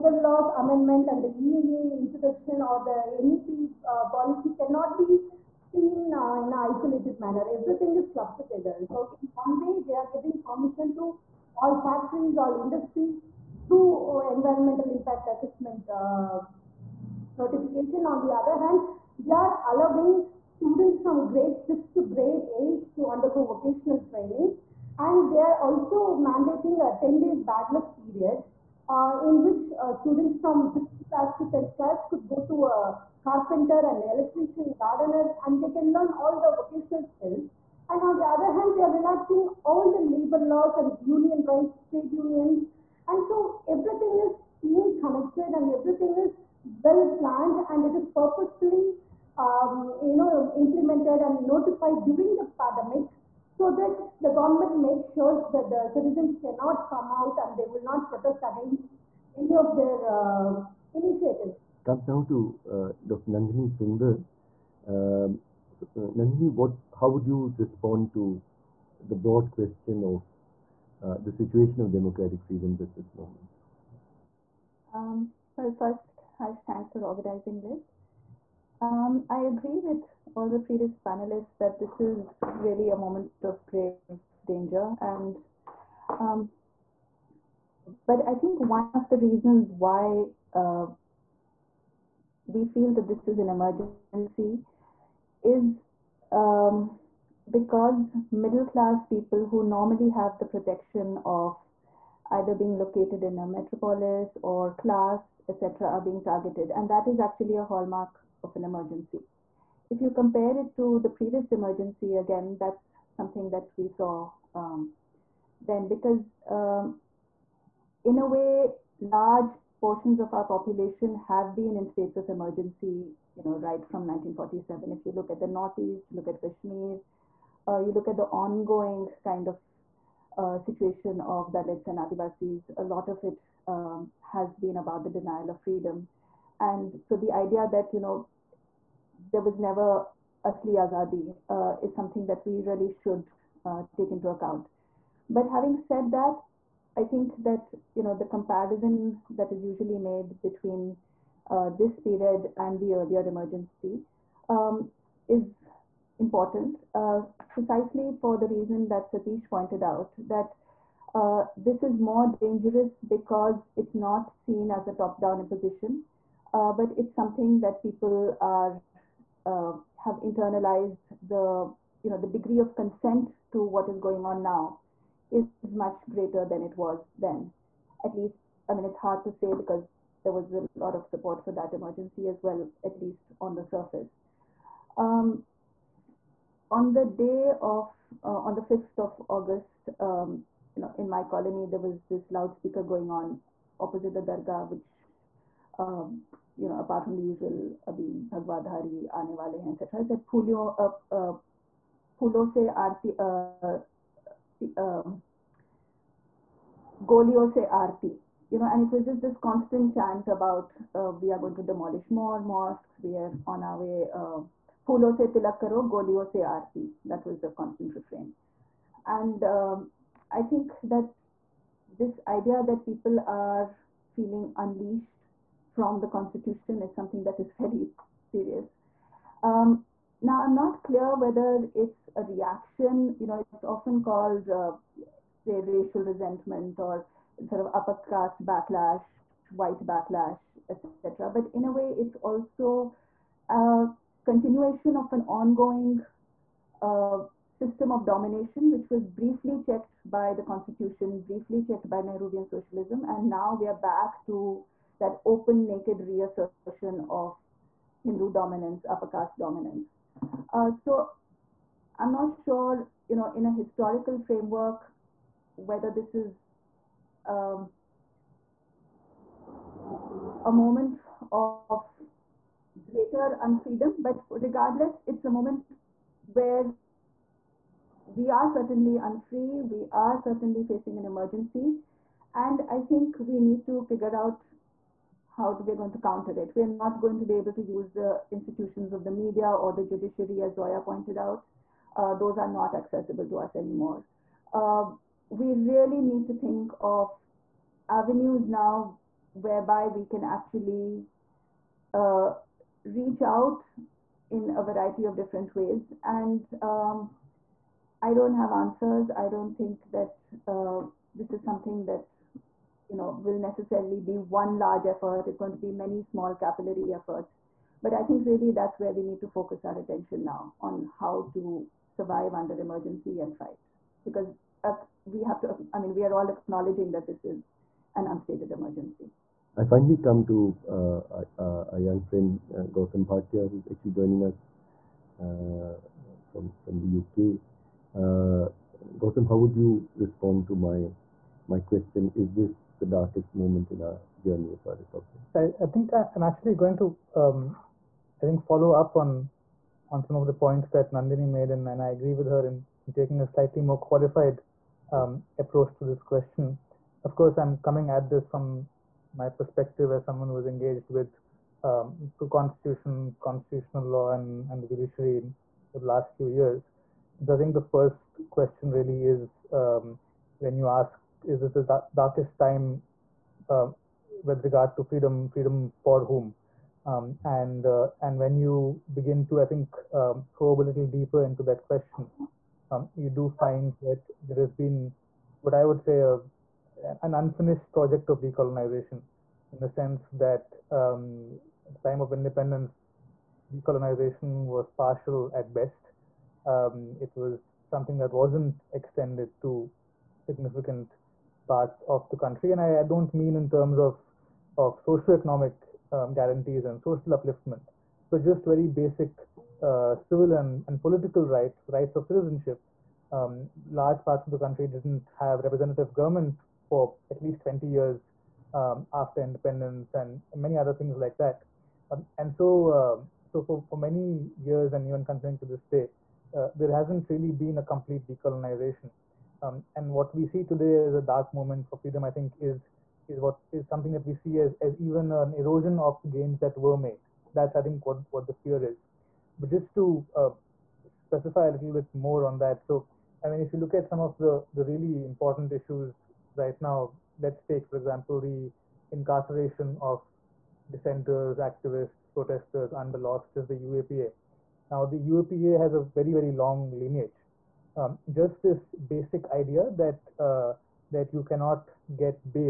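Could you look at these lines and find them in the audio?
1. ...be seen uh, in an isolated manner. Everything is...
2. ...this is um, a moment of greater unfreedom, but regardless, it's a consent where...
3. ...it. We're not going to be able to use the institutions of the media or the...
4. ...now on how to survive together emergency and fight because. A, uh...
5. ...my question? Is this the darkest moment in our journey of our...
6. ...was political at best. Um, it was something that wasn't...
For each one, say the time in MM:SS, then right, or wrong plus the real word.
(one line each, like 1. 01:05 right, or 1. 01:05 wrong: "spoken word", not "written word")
1. 00:04 right
2. 04:25 wrong: "moment", not "consent"
3. 04:46 right
4. 05:20 wrong: "under", not "together"
5. 05:41 right
6. 06:34 wrong: "partial", not "political".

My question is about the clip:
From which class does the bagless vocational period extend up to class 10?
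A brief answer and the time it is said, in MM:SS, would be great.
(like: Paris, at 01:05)
6th class, at 00:30.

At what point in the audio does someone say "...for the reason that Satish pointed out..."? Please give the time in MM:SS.
02:38.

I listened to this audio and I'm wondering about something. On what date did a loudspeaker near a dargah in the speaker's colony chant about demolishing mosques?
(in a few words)
5th of August.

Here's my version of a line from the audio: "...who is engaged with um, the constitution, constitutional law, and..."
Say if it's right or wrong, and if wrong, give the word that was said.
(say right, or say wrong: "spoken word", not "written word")
right.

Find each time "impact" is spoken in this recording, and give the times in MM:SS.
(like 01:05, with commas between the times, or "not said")
00:14.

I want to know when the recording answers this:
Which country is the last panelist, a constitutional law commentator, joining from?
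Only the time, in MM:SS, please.
05:36.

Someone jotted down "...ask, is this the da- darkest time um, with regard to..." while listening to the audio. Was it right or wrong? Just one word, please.
right.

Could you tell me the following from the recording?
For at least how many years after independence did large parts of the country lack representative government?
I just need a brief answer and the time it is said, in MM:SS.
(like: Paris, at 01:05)
20 years, at 06:57.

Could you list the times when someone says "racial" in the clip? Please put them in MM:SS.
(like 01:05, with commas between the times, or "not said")
03:55.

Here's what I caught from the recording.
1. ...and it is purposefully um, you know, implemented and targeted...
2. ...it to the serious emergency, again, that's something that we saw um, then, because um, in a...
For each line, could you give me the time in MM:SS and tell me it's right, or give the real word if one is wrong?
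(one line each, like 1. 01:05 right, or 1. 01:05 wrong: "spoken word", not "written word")
1. 00:47 wrong: "notified", not "targeted"
2. 01:50 wrong: "previous", not "serious".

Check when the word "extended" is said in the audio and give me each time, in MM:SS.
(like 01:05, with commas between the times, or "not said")
06:38.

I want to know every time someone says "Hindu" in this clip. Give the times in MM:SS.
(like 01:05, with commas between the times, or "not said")
04:18.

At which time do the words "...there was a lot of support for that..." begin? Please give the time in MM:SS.
03:00.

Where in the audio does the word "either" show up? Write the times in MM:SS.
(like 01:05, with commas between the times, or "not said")
01:42.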